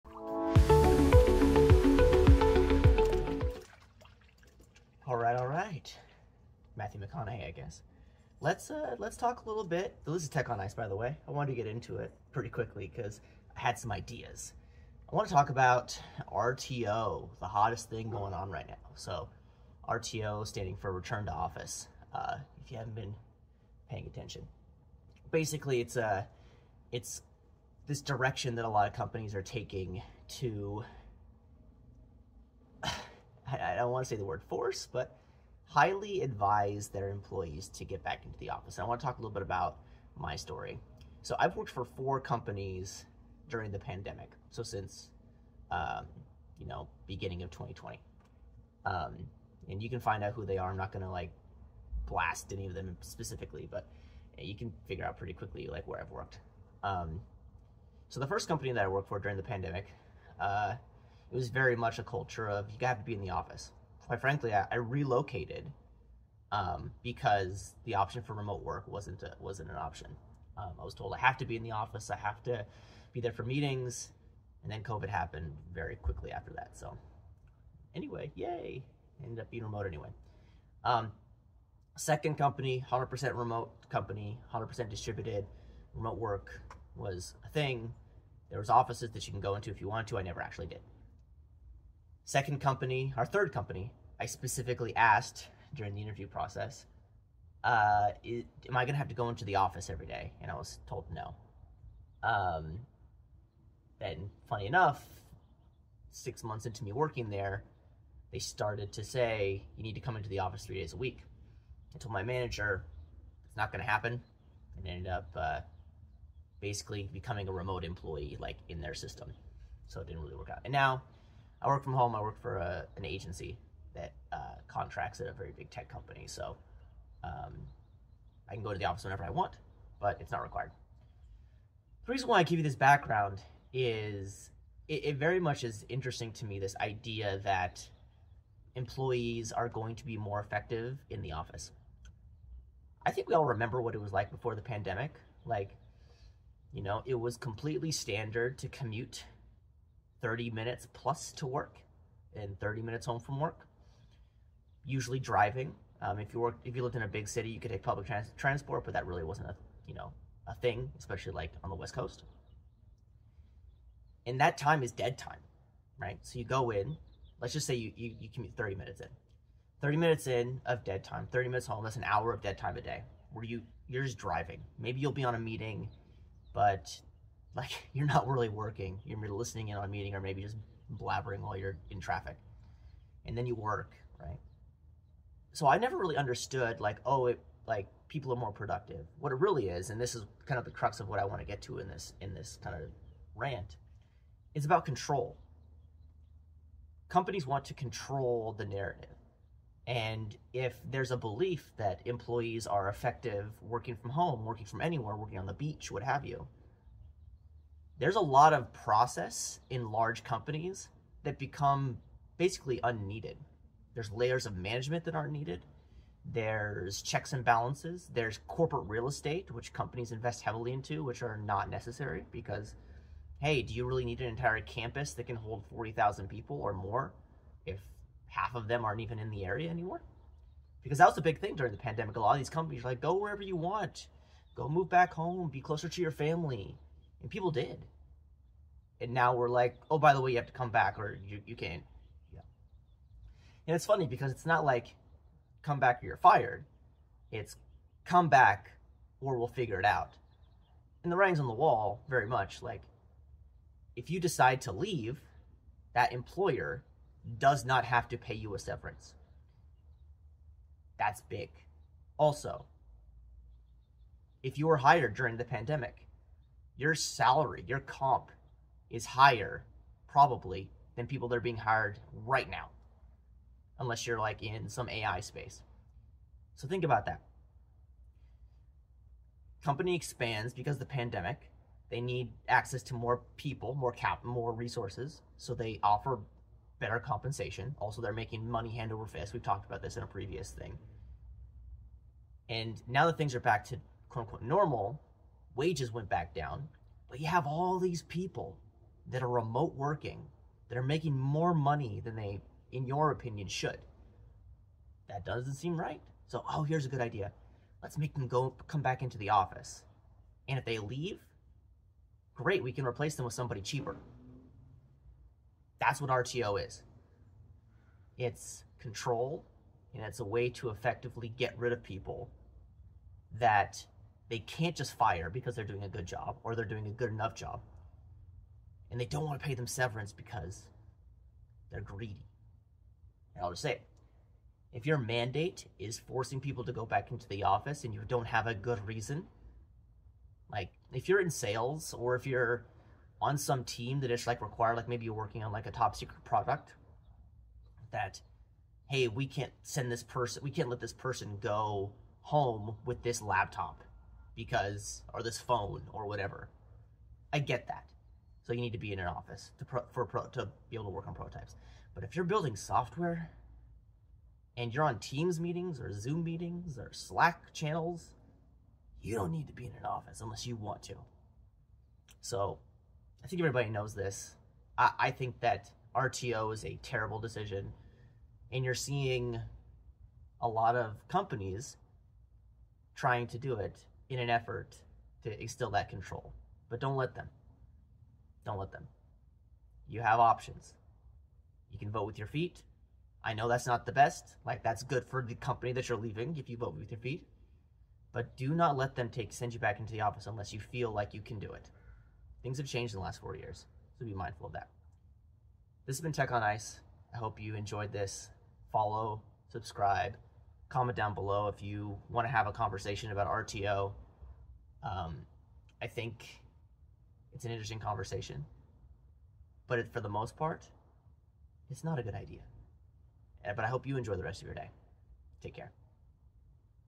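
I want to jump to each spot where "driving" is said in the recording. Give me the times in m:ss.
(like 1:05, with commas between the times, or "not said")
2:35, 2:54.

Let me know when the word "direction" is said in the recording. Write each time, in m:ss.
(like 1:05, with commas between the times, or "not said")
0:28.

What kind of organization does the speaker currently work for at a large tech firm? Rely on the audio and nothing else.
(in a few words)
an agency.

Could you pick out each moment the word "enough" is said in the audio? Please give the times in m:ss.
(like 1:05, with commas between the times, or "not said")
1:44, 5:27.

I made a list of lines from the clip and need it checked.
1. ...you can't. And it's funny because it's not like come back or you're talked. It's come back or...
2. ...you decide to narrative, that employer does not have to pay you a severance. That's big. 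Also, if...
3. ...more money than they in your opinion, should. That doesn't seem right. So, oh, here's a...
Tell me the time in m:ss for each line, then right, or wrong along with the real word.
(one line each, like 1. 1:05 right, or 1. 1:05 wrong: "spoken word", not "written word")
1. 4:01 wrong: "fired", not "talked"
2. 4:14 wrong: "leave", not "narrative"
3. 5:01 right.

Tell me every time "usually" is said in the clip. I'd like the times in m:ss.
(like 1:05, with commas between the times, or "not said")
2:34.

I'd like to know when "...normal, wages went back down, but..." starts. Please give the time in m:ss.
4:54.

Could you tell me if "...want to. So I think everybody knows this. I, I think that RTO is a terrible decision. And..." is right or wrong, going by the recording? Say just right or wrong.
right.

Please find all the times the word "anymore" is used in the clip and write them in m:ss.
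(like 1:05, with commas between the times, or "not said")
3:49.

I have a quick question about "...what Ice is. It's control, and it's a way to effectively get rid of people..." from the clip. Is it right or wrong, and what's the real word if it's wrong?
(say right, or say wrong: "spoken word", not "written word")
wrong: "RTO", not "Ice".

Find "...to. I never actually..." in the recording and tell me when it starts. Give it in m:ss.
1:30.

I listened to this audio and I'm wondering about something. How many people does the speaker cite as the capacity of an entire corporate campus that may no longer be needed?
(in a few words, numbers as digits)
40,000.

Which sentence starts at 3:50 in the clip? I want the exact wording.
Because that was the big thing during the pandemic.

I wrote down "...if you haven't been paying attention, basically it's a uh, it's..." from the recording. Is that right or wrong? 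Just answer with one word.
right.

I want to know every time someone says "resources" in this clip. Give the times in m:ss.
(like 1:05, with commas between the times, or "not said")
4:44.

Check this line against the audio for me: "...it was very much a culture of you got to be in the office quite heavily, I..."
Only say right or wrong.
wrong.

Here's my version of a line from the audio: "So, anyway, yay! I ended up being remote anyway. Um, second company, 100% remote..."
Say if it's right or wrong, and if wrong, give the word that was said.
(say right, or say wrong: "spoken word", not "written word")
right.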